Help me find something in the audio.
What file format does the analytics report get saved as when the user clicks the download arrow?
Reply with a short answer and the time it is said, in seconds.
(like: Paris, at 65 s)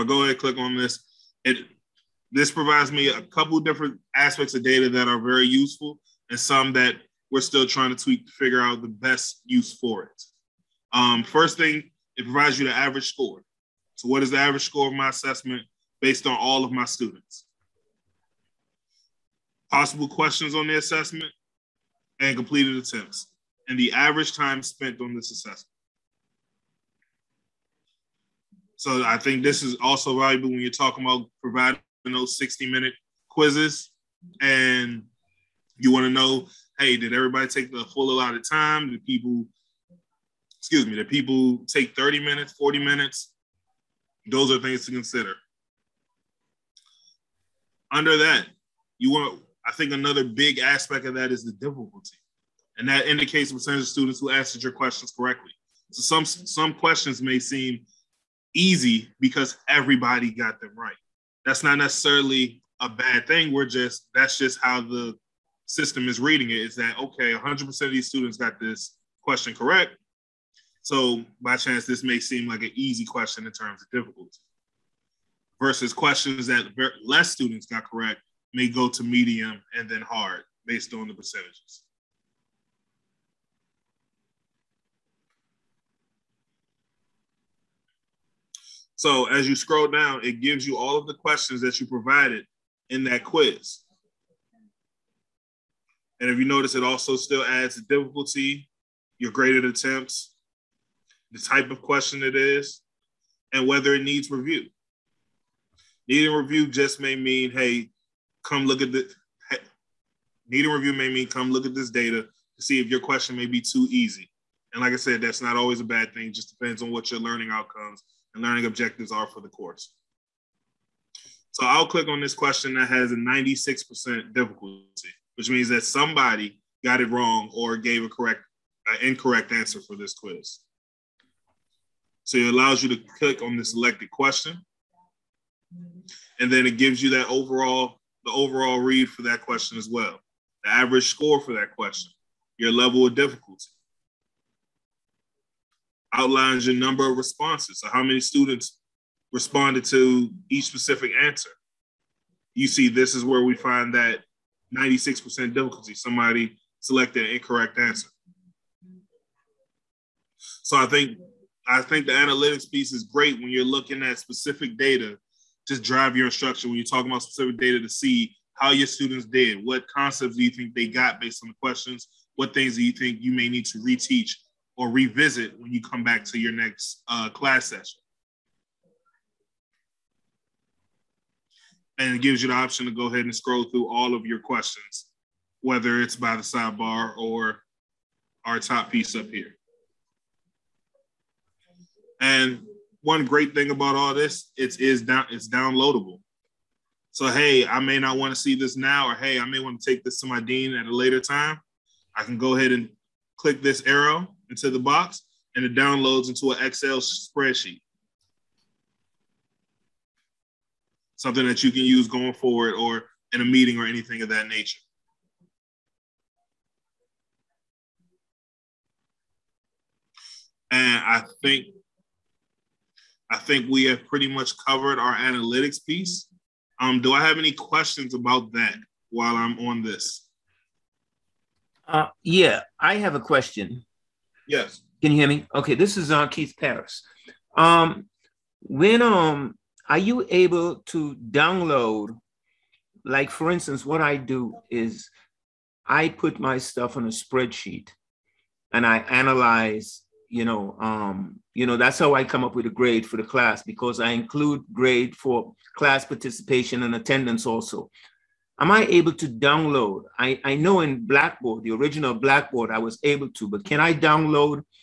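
Excel spreadsheet, at 206 s.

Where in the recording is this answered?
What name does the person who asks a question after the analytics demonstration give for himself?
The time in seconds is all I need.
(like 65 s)
236 s.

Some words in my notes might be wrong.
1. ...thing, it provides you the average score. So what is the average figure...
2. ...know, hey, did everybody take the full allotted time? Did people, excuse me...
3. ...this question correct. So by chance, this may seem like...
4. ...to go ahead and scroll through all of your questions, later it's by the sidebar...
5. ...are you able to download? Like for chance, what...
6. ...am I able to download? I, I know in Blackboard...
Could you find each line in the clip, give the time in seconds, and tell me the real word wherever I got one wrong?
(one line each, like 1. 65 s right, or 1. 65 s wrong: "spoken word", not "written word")
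1. 11 s wrong: "score", not "figure"
2. 36 s right
3. 68 s right
4. 182 s wrong: "whether", not "later"
5. 239 s wrong: "instance", not "chance"
6. 258 s right.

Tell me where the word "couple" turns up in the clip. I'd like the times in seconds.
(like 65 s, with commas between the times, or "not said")
3 s.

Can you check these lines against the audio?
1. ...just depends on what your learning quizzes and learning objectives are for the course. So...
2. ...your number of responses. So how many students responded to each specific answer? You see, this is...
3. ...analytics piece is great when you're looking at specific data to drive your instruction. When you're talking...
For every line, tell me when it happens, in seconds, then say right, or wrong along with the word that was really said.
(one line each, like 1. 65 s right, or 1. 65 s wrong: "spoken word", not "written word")
1. 116 s wrong: "outcomes", not "quizzes"
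2. 146 s right
3. 162 s right.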